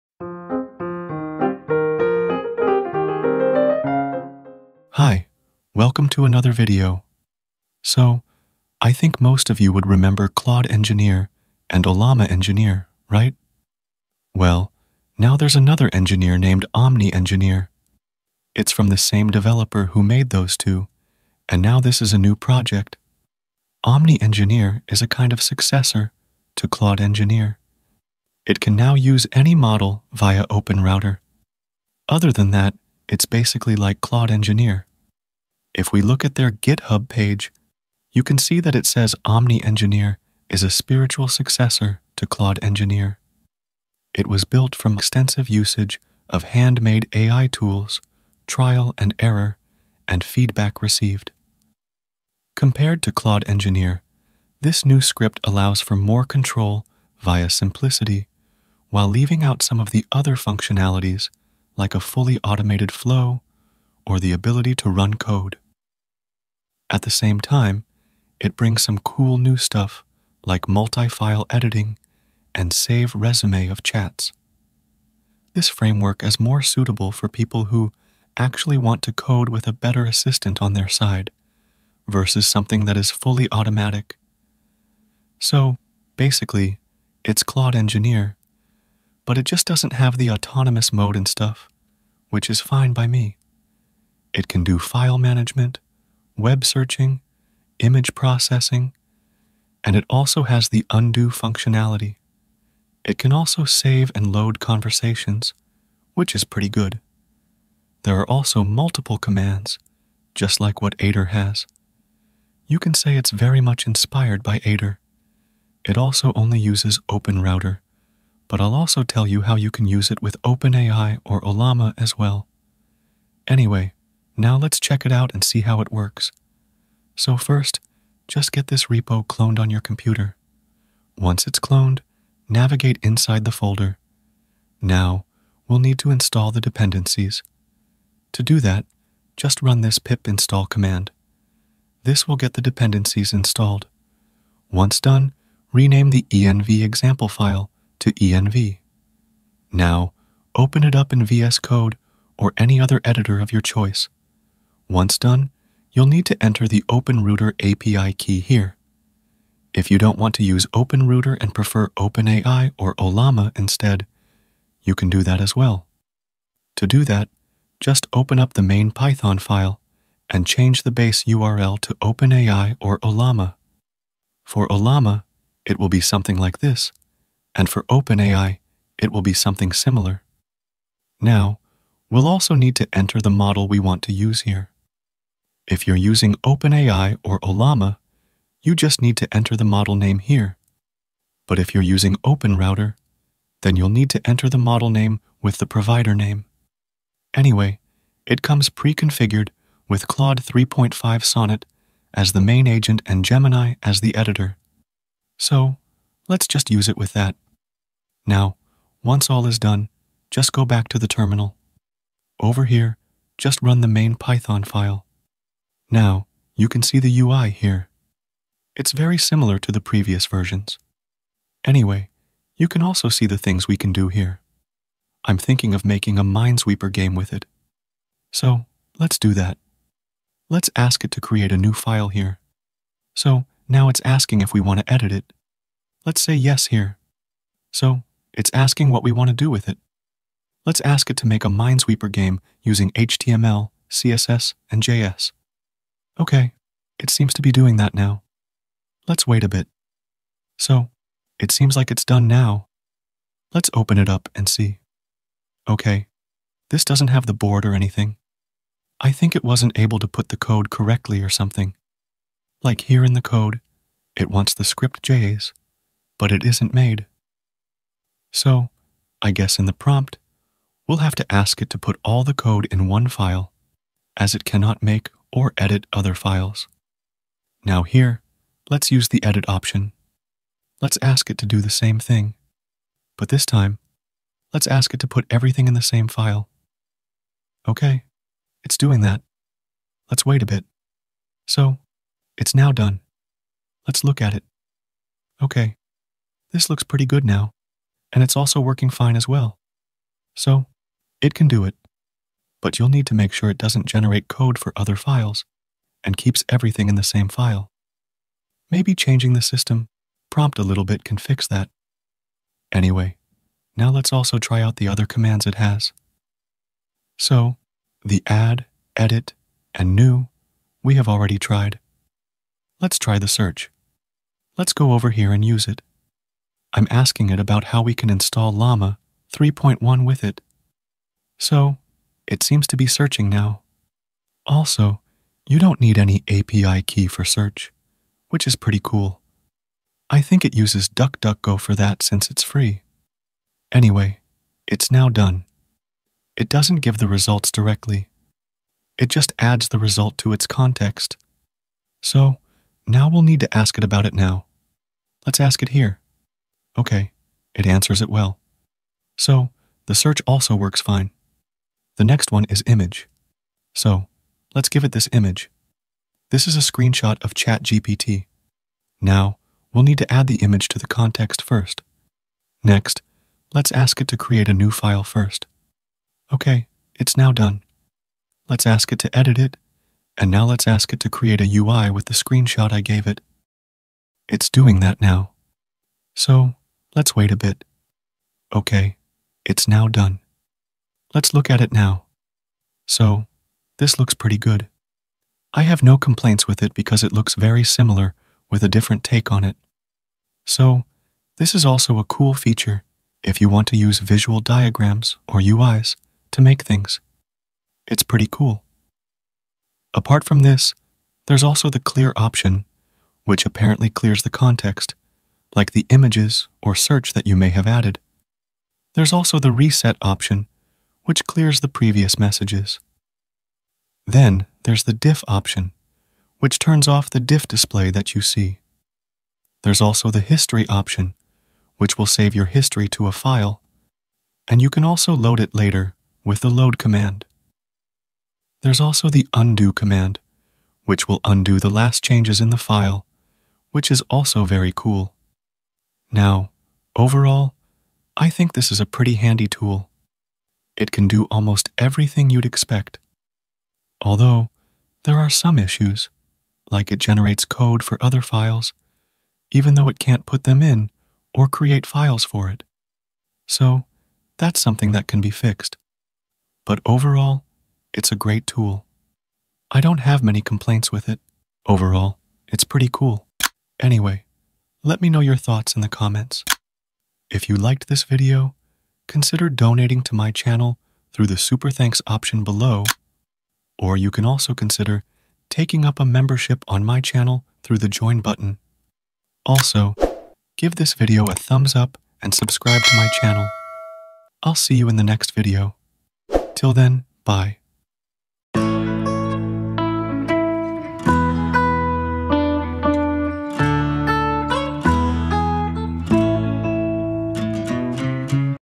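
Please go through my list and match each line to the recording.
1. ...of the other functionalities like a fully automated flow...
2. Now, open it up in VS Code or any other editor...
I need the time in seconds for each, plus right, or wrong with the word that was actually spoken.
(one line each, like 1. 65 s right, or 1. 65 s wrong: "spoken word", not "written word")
1. 59 s right
2. 149 s right.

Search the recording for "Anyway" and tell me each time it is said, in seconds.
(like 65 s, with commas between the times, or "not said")
123 s, 197 s, 221 s, 312 s, 343 s, 473 s.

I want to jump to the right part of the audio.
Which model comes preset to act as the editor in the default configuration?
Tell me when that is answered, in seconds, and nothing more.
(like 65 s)
203 s.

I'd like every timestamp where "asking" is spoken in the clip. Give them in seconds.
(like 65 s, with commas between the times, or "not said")
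234 s, 238 s, 326 s.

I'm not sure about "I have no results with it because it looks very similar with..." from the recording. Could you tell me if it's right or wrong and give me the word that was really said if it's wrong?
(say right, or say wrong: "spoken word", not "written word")
wrong: "complaints", not "results".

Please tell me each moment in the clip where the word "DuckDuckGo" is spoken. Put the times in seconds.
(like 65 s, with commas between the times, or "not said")
340 s.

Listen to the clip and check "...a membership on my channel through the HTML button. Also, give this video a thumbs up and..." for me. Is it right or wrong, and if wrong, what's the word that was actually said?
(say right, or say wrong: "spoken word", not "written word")
wrong: "Join", not "HTML".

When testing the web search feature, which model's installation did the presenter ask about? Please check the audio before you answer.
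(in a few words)
Llama 3.1.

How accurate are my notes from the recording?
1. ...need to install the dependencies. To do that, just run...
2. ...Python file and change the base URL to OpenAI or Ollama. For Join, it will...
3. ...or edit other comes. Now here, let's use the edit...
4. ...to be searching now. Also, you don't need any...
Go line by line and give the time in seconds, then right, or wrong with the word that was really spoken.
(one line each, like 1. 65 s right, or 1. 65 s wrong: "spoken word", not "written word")
1. 135 s right
2. 168 s wrong: "Ollama", not "Join"
3. 275 s wrong: "files", not "comes"
4. 332 s right.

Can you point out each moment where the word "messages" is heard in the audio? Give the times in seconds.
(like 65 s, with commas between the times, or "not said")
422 s.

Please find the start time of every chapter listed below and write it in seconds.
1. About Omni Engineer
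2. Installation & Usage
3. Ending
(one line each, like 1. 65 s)
1. 14 s
2. 126 s
3. 473 s.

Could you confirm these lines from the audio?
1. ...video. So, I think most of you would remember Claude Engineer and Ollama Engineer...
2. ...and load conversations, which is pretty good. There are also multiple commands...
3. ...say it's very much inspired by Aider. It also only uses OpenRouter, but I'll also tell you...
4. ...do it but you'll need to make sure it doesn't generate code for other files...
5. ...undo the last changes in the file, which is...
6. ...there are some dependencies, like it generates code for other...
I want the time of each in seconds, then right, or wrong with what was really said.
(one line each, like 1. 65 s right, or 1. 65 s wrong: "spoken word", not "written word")
1. 6 s right
2. 104 s right
3. 112 s right
4. 301 s right
5. 441 s right
6. 455 s wrong: "issues", not "dependencies".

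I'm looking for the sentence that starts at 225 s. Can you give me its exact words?
I'm thinking of making a Minesweeper game with it.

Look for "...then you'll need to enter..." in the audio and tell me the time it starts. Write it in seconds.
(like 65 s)
193 s.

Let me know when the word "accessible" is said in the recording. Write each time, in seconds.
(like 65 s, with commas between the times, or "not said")
not said.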